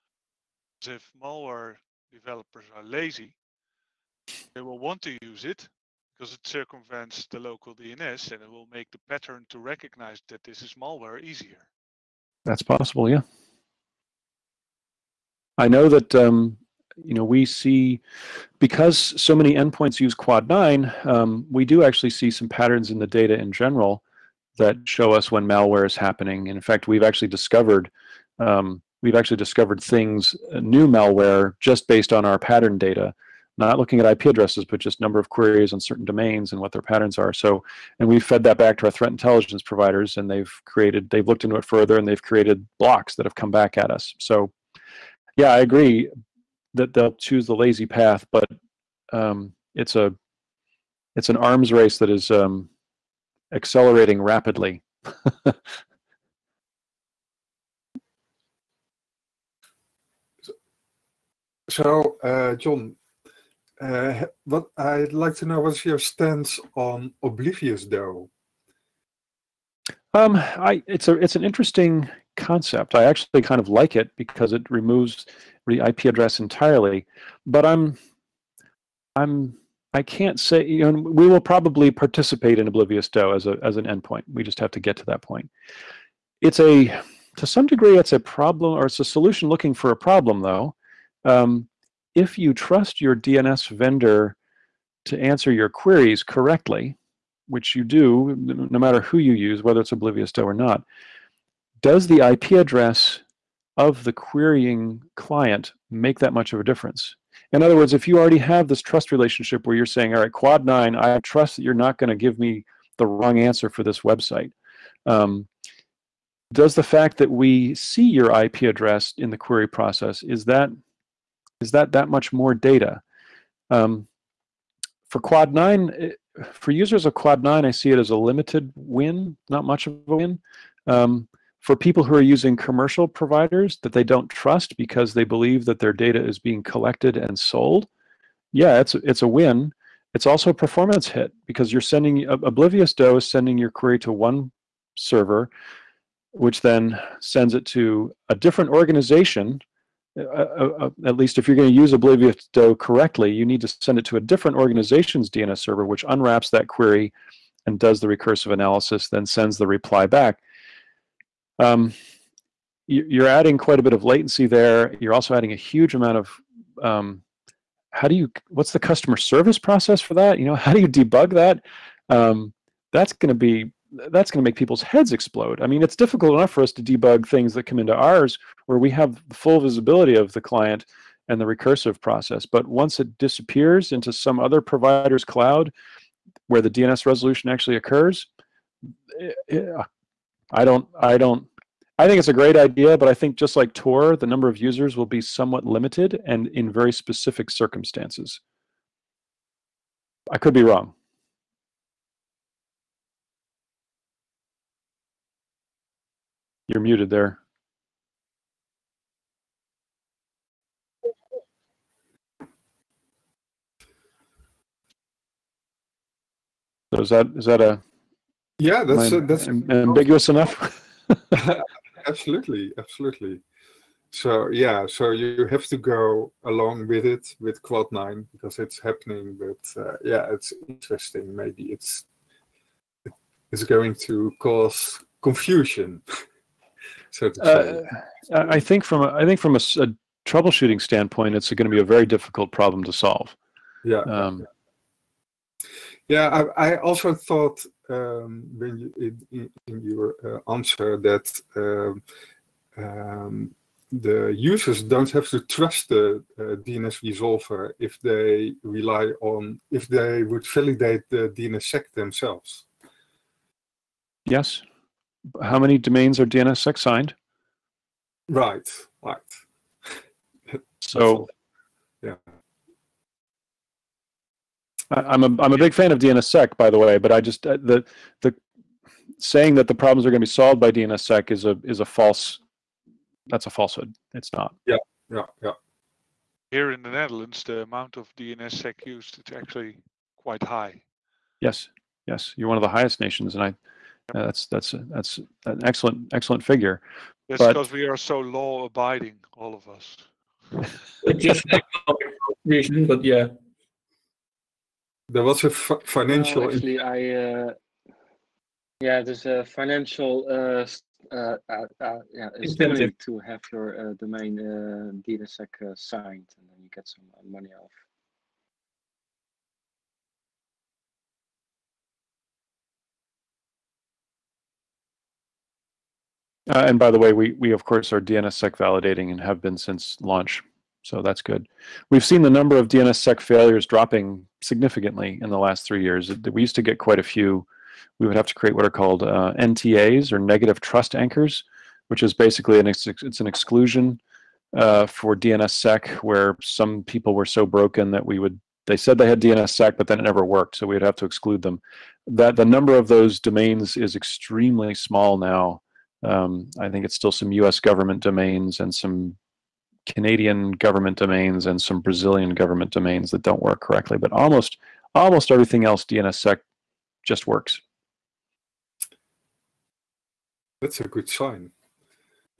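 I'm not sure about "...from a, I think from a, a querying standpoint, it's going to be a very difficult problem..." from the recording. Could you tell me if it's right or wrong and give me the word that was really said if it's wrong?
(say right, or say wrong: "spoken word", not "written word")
wrong: "troubleshooting", not "querying".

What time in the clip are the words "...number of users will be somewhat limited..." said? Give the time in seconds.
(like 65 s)
194 s.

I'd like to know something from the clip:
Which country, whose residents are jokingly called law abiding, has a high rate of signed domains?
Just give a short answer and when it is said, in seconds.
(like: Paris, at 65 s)
the Netherlands, at 286 s.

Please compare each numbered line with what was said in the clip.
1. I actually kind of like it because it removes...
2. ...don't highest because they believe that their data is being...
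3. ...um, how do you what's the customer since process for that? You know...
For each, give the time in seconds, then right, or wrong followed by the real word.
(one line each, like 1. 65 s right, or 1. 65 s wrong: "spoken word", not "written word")
1. 72 s right
2. 134 s wrong: "trust", not "highest"
3. 166 s wrong: "service", not "since".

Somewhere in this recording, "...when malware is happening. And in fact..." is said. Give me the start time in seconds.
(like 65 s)
25 s.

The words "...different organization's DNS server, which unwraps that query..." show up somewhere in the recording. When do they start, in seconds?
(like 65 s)
154 s.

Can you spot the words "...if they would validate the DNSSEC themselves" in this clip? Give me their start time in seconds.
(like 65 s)
259 s.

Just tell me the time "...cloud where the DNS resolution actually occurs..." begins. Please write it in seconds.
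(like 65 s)
185 s.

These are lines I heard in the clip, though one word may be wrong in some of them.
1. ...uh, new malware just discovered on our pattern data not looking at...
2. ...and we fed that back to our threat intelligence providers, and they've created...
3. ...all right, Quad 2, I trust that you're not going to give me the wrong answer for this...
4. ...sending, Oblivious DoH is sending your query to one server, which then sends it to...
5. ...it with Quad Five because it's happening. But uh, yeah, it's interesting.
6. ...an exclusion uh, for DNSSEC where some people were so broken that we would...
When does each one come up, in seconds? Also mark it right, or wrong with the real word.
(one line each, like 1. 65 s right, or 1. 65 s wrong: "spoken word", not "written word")
1. 30 s wrong: "based", not "discovered"
2. 37 s right
3. 110 s wrong: "9", not "2"
4. 141 s right
5. 227 s wrong: "Nine", not "Five"
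6. 343 s right.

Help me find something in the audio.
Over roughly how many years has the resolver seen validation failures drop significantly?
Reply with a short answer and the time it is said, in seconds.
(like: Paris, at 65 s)
3, at 335 s.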